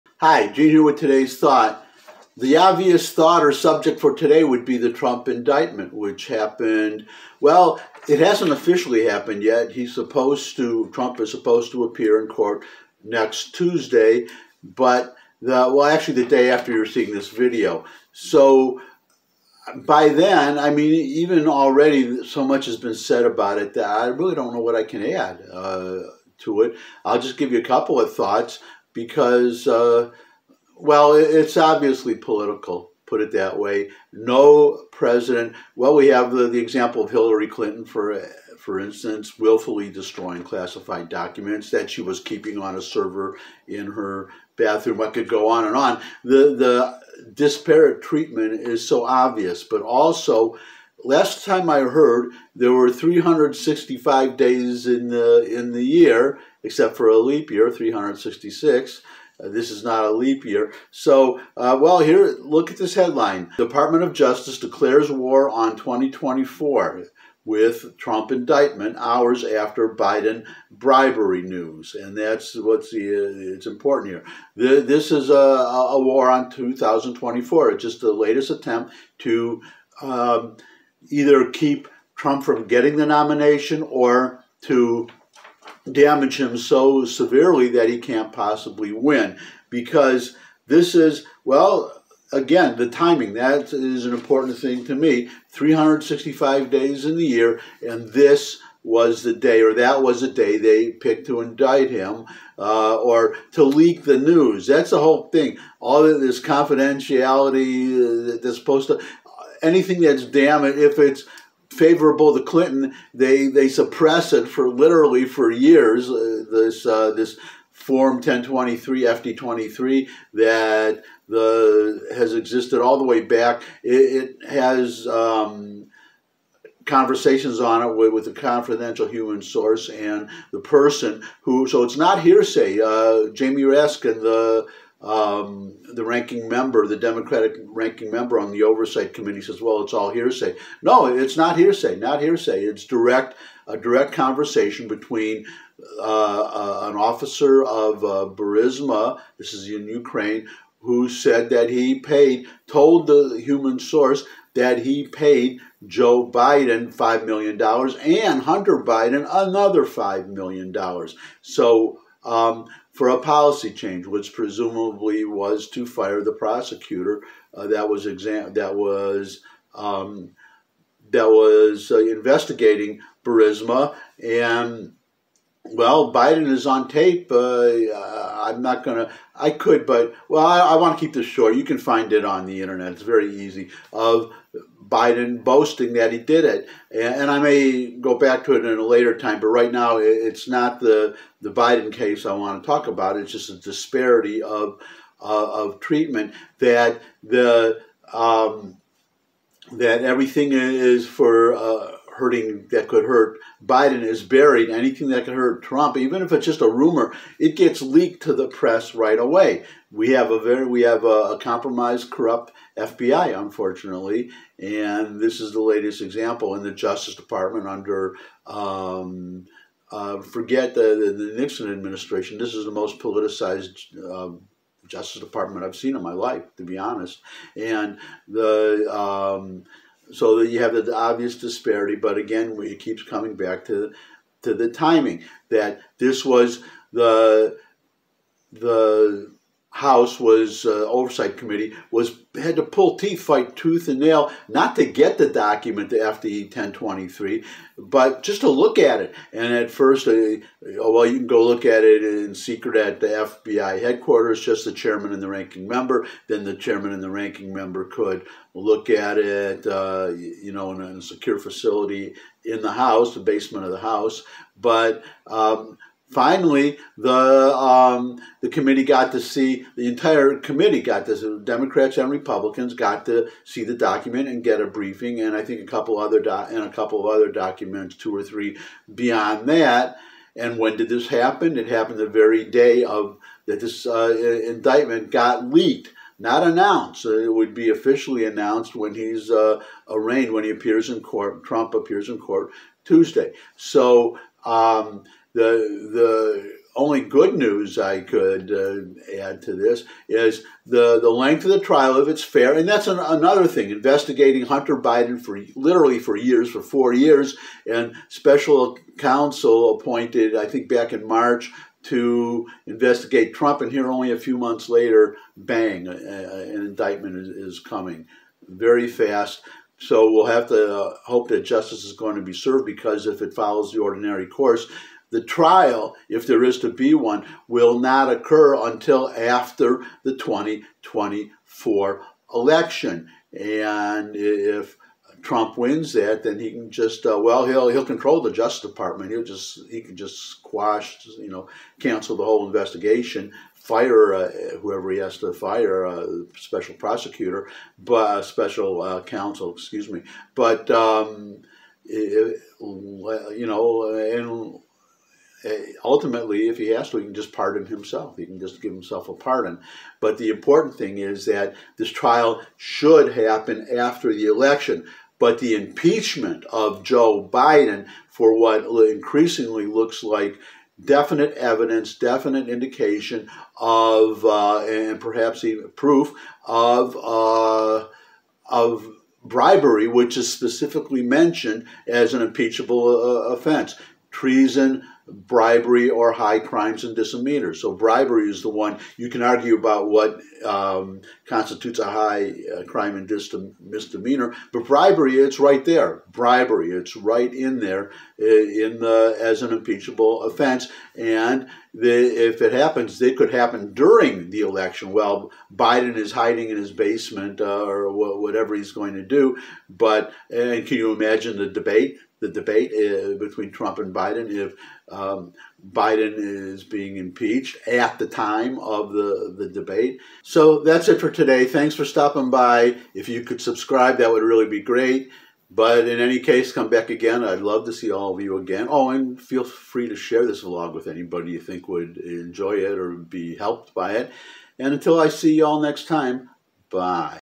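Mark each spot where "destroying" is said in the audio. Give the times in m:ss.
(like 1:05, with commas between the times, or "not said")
0:39.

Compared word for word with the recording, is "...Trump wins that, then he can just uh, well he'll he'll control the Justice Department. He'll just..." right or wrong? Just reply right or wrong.
right.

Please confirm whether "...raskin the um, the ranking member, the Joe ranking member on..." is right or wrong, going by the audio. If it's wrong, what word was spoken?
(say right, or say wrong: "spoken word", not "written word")
wrong: "Democratic", not "Joe".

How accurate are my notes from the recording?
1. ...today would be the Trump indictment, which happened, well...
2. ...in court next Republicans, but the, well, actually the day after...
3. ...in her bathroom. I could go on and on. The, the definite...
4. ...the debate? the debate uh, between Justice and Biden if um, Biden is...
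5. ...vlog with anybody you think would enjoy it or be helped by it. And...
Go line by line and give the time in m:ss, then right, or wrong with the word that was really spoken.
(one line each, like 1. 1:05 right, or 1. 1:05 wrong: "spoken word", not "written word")
1. 0:04 right
2. 0:12 wrong: "Tuesday", not "Republicans"
3. 0:43 wrong: "disparate", not "definite"
4. 6:51 wrong: "Trump", not "Justice"
5. 7:10 right.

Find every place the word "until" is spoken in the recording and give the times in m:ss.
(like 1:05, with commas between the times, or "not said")
5:28, 7:14.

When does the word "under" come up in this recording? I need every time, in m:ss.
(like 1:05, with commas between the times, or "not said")
3:37.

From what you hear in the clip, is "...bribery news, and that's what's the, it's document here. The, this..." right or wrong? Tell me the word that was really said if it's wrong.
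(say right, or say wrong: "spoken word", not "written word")
wrong: "important", not "document".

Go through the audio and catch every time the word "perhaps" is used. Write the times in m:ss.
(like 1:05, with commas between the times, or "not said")
6:14.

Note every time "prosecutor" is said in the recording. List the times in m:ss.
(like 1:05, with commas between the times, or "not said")
2:46, 5:46.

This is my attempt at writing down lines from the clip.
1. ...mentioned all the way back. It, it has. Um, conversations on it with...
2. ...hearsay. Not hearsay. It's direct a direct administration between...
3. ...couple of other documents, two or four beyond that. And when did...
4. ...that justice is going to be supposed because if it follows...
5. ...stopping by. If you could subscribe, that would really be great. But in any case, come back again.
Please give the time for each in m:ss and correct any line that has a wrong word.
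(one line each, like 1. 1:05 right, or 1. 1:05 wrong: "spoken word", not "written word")
1. 2:02 wrong: "existed", not "mentioned"
2. 2:21 wrong: "conversation", not "administration"
3. 4:36 wrong: "three", not "four"
4. 5:21 wrong: "served", not "supposed"
5. 7:01 right.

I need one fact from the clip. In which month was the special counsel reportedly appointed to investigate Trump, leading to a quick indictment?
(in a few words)
March.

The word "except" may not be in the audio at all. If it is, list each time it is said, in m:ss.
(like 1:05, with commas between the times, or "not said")
0:56.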